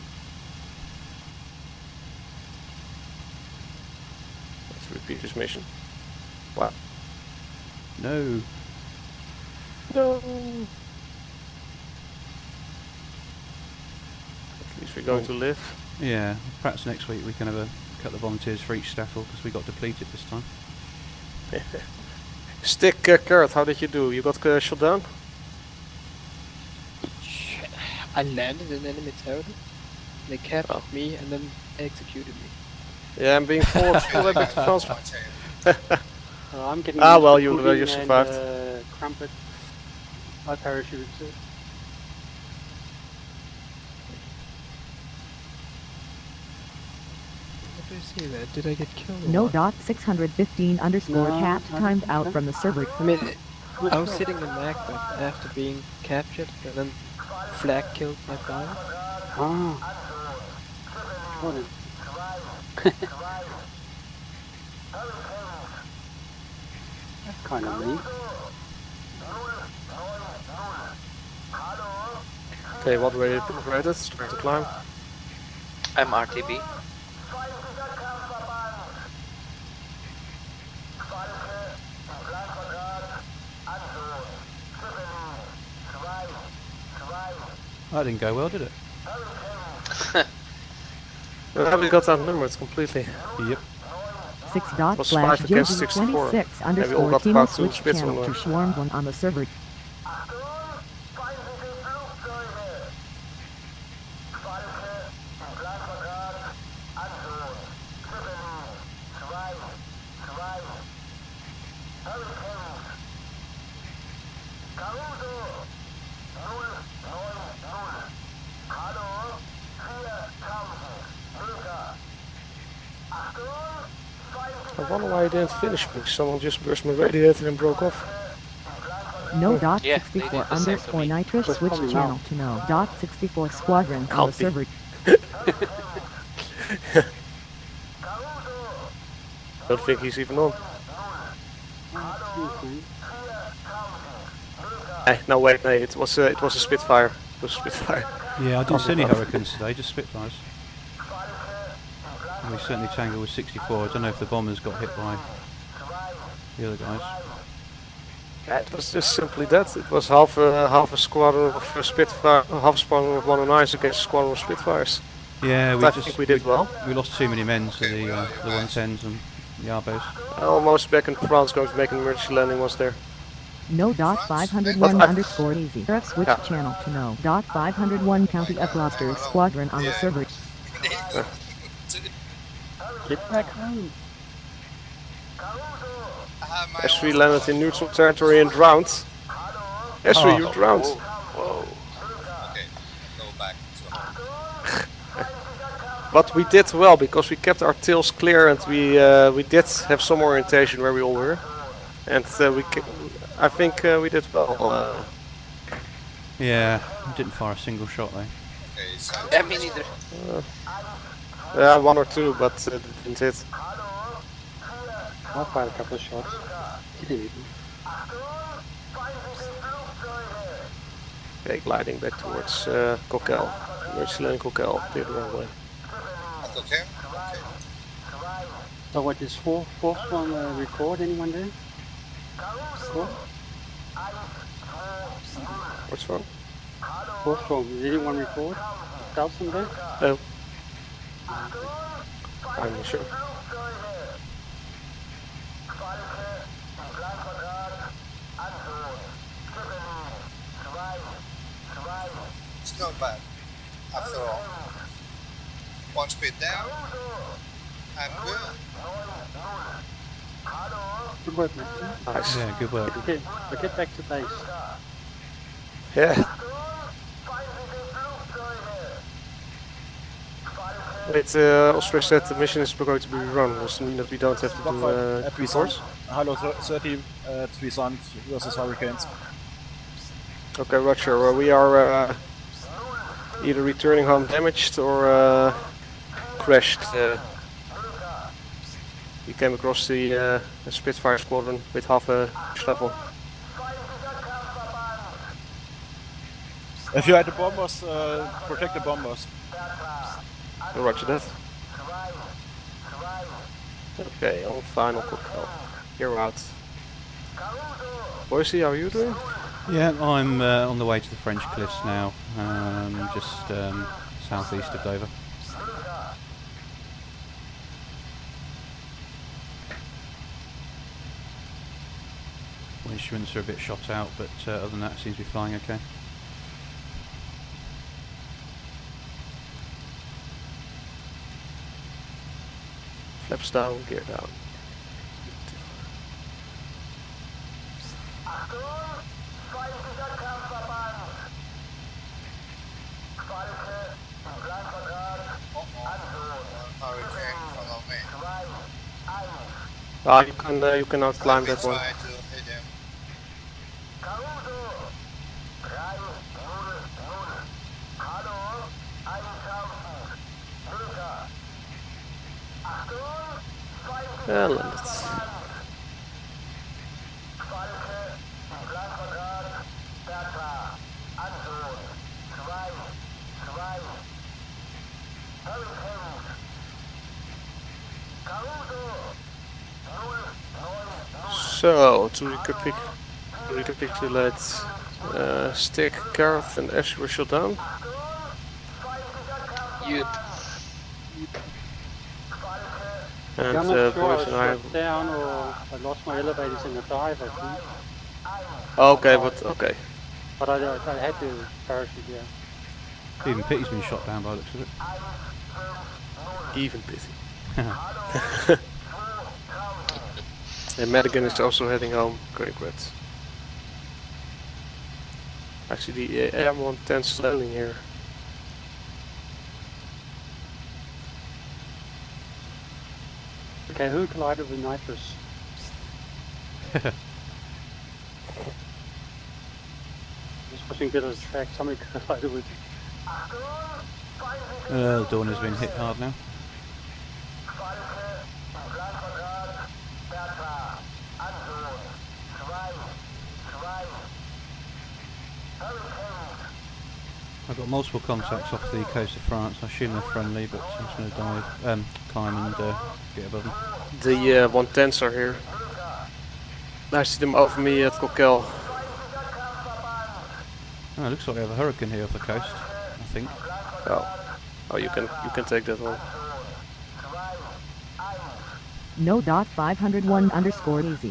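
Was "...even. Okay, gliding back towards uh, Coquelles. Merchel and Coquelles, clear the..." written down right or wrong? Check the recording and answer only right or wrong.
right.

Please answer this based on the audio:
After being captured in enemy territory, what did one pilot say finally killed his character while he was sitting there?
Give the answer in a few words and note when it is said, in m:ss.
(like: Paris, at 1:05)
Flak, at 0:57.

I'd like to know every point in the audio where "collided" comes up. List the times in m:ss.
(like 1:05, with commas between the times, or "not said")
7:04, 7:12.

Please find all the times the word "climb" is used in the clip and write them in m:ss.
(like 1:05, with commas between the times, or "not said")
1:14, 5:51, 7:32.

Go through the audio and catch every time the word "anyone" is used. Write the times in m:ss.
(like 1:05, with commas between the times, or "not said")
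3:51, 3:57.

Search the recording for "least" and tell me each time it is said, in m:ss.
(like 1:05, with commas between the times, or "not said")
0:14.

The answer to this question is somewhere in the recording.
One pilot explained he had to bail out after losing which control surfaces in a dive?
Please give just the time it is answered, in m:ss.
6:36.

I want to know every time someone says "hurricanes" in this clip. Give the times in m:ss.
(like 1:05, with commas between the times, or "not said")
2:29, 4:38, 7:41.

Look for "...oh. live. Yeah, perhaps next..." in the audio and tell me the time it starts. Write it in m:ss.
0:15.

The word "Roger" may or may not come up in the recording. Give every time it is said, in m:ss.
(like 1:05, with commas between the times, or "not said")
4:40, 5:00.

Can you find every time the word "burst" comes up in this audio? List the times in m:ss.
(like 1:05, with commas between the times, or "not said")
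2:06.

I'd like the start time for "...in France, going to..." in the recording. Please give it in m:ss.
2:51.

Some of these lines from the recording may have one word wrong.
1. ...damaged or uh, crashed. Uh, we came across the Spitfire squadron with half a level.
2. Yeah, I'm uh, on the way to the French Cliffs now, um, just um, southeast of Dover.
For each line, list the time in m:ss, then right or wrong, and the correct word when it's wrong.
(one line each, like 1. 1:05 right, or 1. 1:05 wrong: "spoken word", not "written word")
1. 4:44 right
2. 5:09 right.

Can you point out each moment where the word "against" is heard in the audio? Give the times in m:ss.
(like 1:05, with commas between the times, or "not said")
2:43.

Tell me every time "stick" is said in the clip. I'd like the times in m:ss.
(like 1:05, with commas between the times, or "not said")
0:22, 6:25.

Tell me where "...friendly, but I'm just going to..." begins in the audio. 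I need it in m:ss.
7:30.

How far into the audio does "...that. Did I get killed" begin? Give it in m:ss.
0:48.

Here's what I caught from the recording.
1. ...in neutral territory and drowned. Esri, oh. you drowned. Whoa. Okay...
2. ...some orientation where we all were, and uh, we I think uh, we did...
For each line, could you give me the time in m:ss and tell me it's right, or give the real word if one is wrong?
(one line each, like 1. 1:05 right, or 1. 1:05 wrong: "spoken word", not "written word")
1. 3:07 right
2. 3:20 right.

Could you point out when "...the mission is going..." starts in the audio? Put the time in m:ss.
4:32.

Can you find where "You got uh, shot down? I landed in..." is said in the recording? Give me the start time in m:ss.
0:24.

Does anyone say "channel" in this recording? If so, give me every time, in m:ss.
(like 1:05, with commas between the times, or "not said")
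1:37, 2:11, 2:56.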